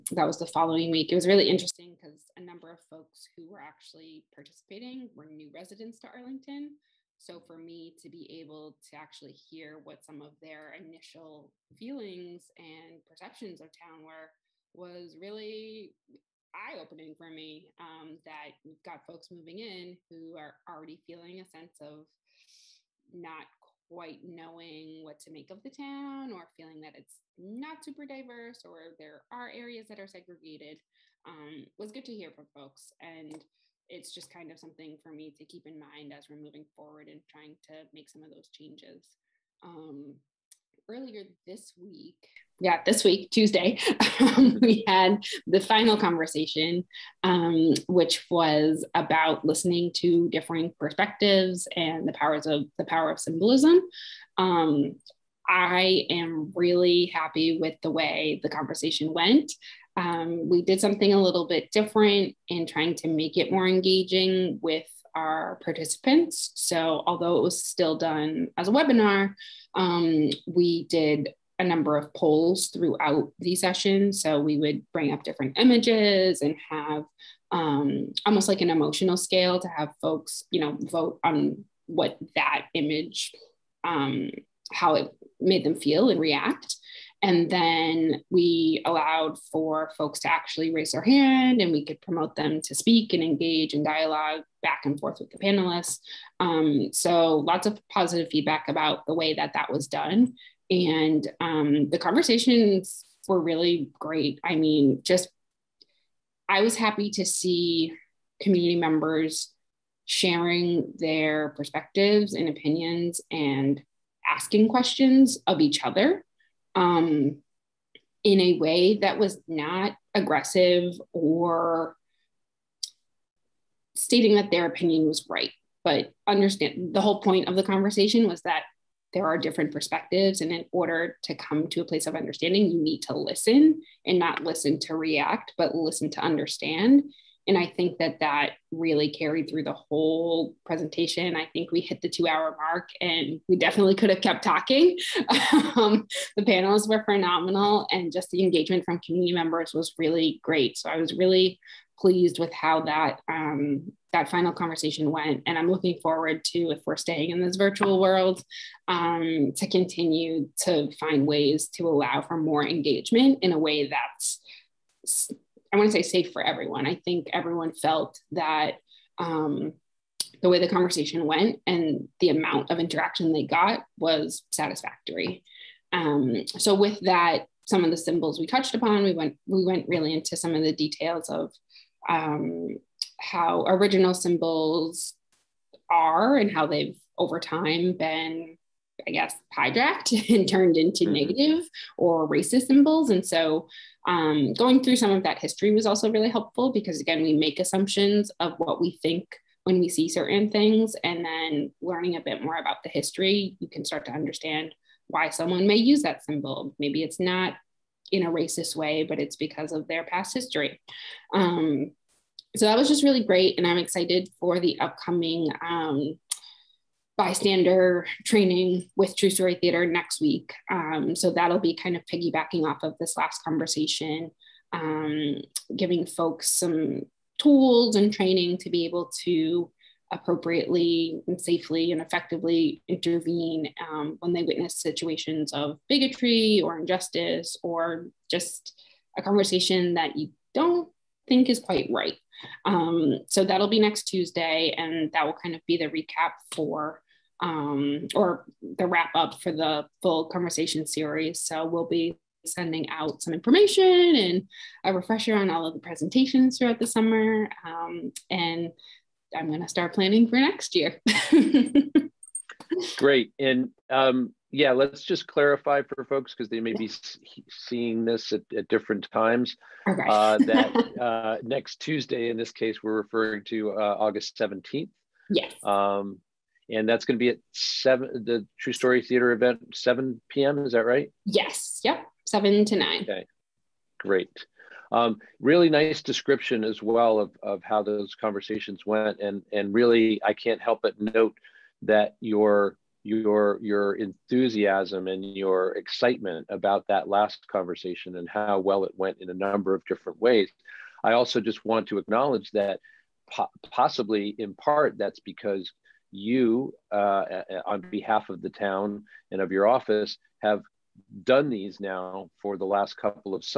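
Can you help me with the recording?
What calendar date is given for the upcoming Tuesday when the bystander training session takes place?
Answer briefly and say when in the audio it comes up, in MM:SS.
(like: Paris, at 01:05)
August 17th, at 04:33.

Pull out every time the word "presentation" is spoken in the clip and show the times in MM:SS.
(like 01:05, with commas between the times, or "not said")
02:20, 04:15.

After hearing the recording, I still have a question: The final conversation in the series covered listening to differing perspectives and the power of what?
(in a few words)
symbolism.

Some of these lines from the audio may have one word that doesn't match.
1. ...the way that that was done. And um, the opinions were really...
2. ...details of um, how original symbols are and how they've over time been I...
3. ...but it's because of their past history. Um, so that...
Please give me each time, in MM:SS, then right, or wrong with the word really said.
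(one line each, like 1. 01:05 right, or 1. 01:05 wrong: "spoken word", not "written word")
1. 01:39 wrong: "conversations", not "opinions"
2. 03:00 right
3. 03:29 right.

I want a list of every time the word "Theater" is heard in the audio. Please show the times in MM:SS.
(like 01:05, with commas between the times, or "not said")
03:39, 04:39.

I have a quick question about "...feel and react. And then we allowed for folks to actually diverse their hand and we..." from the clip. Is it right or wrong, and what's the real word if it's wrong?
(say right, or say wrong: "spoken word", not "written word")
wrong: "raise", not "diverse".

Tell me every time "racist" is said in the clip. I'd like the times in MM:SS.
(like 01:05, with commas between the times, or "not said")
03:12, 03:28.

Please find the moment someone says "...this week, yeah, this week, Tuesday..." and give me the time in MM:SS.
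00:41.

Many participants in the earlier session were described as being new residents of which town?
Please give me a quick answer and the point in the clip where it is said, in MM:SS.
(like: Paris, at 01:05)
Arlington, at 00:06.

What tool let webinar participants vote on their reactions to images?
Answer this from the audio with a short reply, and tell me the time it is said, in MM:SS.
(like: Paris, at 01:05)
polls, at 01:12.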